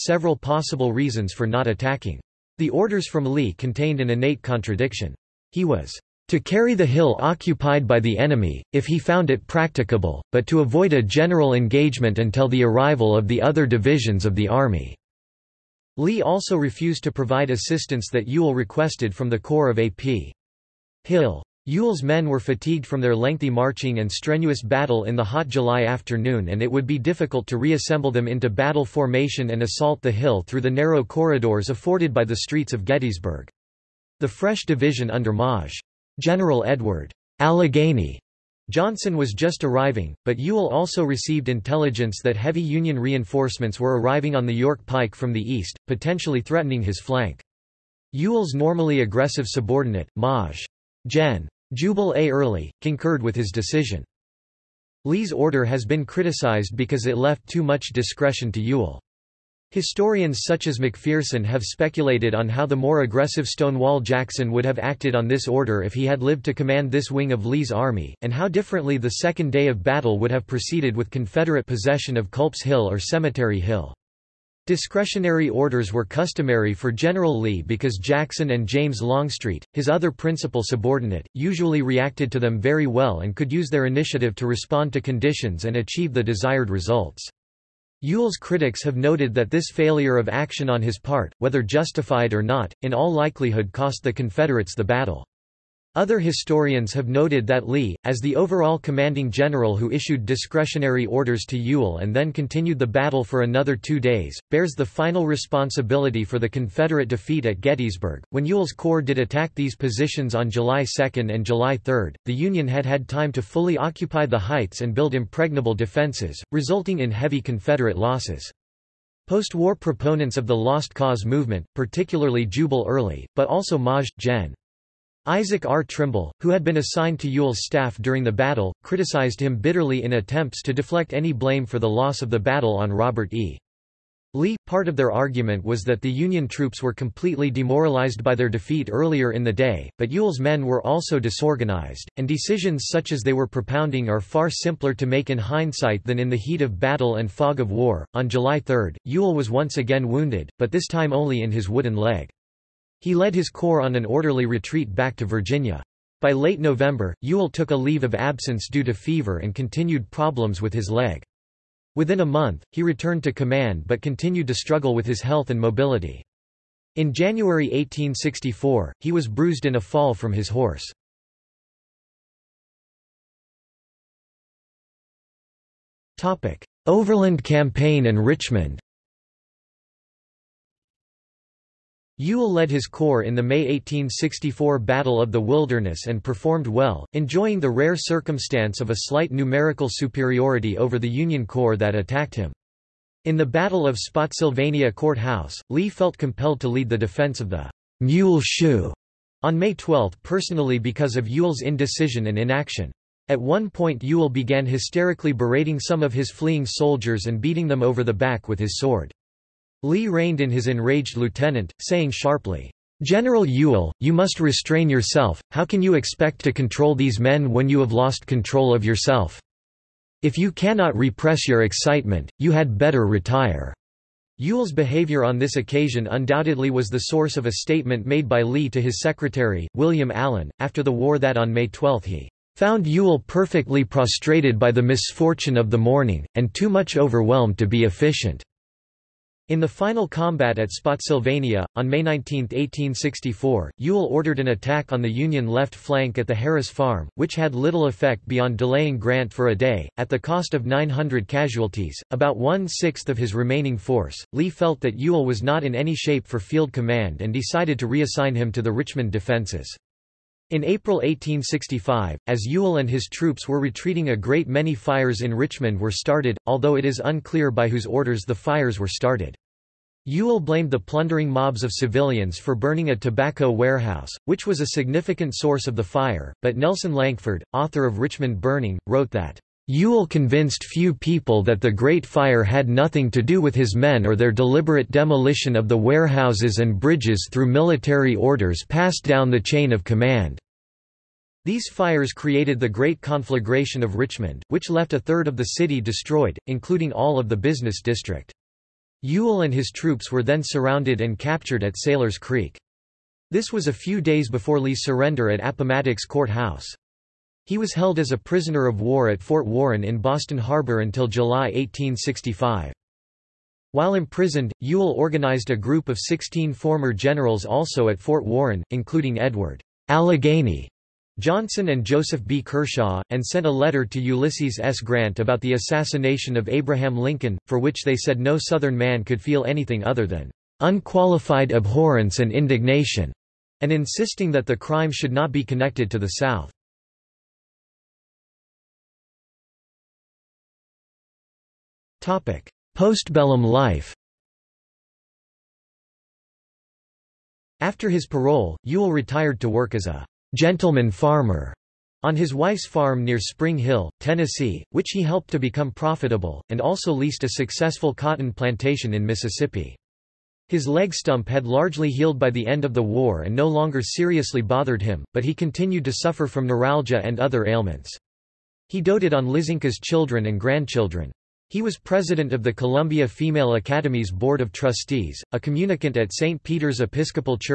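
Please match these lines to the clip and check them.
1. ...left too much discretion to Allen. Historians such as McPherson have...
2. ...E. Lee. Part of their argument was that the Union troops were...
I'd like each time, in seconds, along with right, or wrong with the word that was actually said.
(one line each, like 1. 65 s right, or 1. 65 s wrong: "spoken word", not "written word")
1. 57 s wrong: "Ewell", not "Allen"
2. 133 s right.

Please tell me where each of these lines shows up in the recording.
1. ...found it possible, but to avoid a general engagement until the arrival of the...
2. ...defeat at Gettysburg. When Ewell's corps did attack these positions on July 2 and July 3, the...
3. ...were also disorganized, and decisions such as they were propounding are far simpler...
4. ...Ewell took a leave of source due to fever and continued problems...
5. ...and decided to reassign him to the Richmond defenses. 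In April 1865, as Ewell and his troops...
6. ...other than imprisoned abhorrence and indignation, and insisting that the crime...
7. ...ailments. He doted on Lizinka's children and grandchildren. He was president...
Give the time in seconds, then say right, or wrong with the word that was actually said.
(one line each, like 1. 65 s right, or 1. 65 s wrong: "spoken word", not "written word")
1. 8 s wrong: "practicable", not "possible"
2. 107 s right
3. 140 s right
4. 157 s wrong: "absence", not "source"
5. 257 s right
6. 329 s wrong: "unqualified", not "imprisoned"
7. 367 s right.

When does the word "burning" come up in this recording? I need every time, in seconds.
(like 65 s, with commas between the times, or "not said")
272 s, 278 s.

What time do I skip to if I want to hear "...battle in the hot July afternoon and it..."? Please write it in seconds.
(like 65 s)
24 s.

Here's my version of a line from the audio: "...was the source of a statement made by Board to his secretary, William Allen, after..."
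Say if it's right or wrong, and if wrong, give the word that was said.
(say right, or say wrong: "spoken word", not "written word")
wrong: "Lee", not "Board".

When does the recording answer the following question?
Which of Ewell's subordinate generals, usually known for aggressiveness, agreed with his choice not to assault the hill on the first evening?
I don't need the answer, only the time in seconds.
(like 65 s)
51 s.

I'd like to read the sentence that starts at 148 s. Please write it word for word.
On July 3, Ewell was once again wounded, but this time only in his wooden leg.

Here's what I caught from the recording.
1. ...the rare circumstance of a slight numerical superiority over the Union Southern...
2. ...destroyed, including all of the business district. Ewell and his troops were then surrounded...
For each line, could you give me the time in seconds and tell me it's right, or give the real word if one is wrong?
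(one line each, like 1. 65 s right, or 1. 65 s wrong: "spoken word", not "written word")
1. 187 s wrong: "Corps", not "Southern"
2. 295 s right.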